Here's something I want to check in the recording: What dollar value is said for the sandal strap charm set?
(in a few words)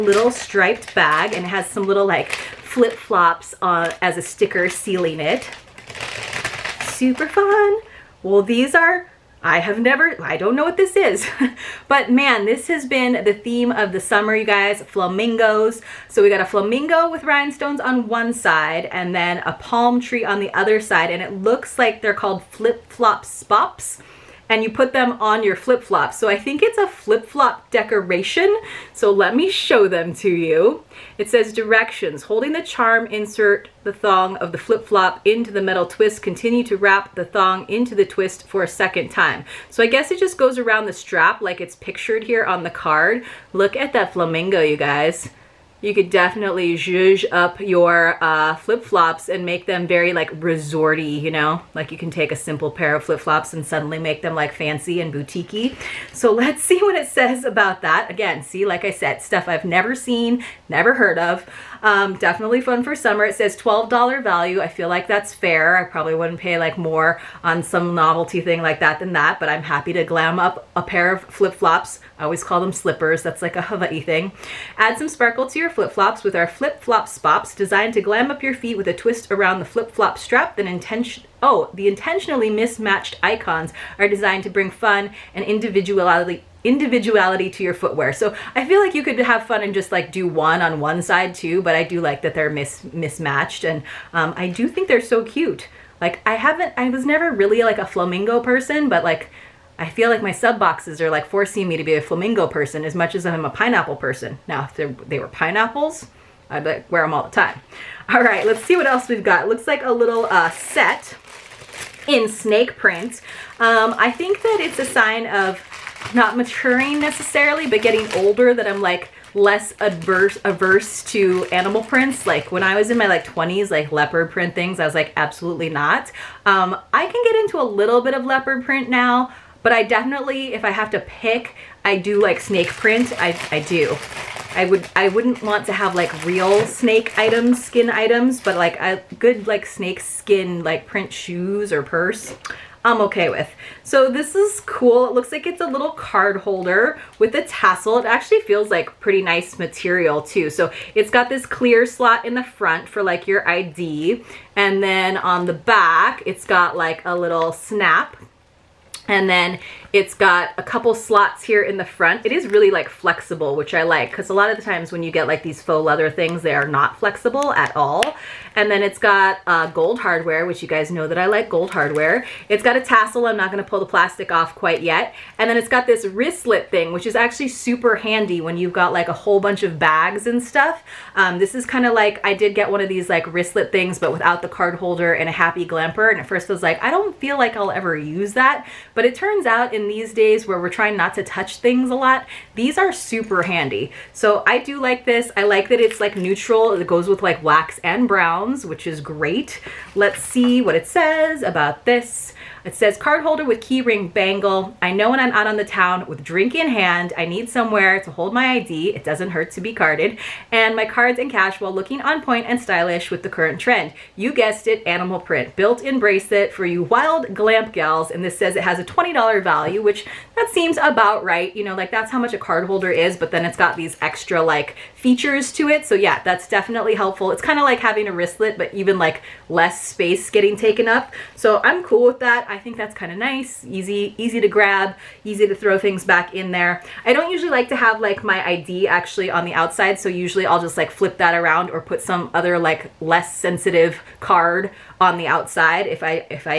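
$12.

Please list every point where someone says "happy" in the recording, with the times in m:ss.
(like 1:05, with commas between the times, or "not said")
1:09, 3:05.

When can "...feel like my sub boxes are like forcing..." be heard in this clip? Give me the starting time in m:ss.
1:39.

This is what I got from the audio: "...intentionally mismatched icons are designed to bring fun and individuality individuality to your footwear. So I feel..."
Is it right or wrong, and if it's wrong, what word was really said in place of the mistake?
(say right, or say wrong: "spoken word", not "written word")
right.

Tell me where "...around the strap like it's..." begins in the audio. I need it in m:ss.
0:40.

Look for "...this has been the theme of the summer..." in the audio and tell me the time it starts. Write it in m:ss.
0:12.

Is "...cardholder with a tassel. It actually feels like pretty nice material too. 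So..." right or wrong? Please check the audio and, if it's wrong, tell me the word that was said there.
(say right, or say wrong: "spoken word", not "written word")
wrong: "holder", not "cardholder".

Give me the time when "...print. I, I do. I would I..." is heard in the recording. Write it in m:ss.
2:12.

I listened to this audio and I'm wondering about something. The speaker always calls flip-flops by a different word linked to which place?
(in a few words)
Hawaii.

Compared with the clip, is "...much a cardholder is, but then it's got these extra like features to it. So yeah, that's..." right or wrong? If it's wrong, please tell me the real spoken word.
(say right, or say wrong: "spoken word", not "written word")
right.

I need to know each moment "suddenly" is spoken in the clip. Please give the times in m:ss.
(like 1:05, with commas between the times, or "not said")
0:53.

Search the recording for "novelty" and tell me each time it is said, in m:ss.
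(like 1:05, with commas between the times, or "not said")
1:07.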